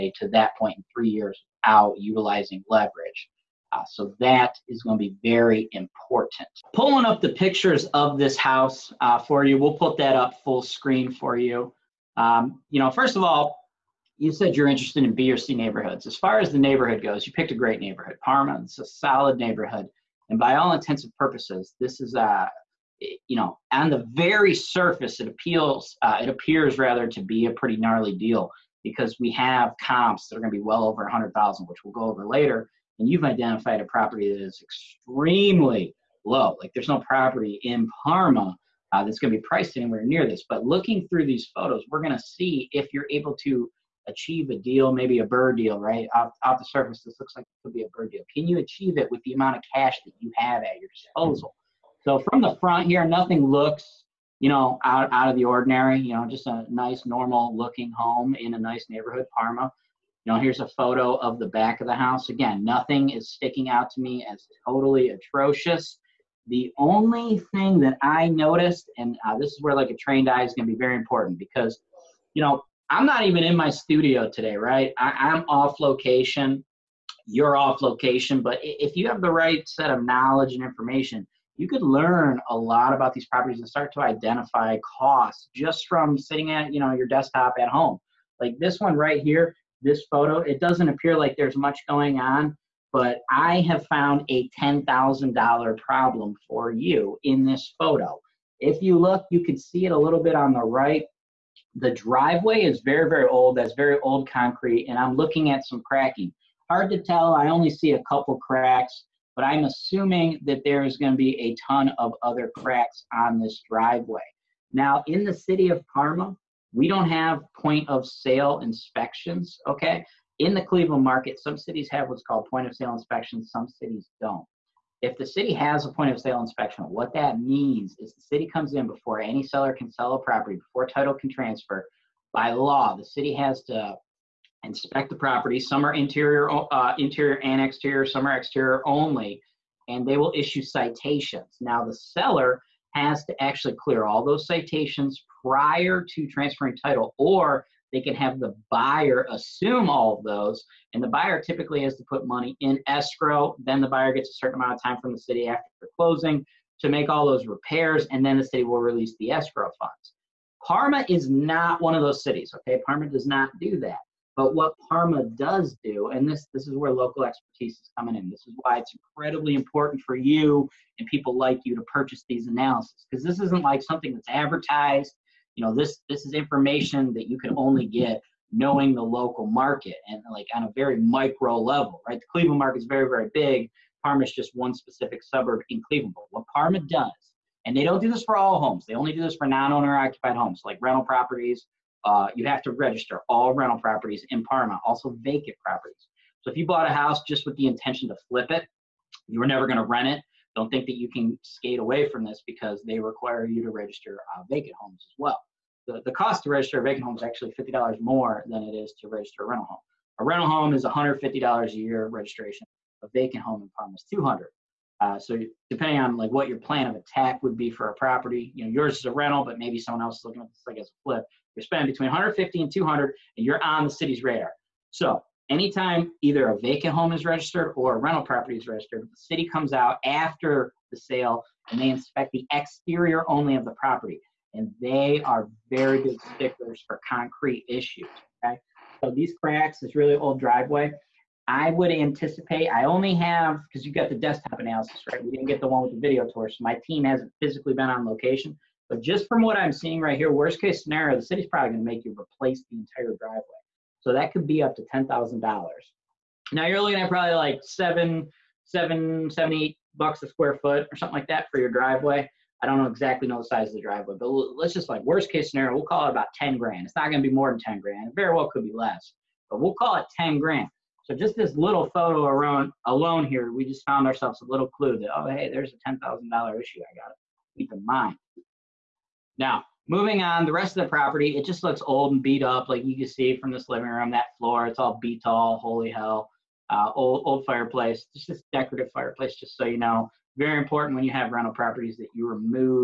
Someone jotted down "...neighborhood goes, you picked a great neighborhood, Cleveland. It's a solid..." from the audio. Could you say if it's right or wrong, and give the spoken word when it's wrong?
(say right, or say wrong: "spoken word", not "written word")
wrong: "Parma", not "Cleveland".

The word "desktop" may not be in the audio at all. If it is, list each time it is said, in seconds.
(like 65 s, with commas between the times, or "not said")
87 s, 244 s.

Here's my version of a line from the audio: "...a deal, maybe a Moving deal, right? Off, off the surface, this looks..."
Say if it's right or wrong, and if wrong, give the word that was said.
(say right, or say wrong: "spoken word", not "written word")
wrong: "BRRRR", not "Moving".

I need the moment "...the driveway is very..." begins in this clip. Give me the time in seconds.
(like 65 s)
101 s.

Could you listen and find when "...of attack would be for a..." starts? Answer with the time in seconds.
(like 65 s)
216 s.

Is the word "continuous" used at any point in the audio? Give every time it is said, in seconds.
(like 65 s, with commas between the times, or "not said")
not said.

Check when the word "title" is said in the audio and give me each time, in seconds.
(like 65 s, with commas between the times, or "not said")
130 s, 146 s.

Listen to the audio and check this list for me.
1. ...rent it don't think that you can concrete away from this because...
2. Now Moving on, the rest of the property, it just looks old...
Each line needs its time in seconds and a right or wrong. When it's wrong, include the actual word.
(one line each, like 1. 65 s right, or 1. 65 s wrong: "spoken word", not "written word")
1. 199 s wrong: "skate", not "concrete"
2. 279 s right.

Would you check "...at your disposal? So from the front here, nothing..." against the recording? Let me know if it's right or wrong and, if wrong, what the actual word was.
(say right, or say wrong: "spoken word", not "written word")
right.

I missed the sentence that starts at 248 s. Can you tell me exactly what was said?
But just from what I'm seeing right here, worst case scenario, the city's probably going to make you replace the entire driveway.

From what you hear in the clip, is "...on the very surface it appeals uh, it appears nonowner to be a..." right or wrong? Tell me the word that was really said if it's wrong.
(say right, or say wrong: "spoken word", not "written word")
wrong: "rather", not "nonowner".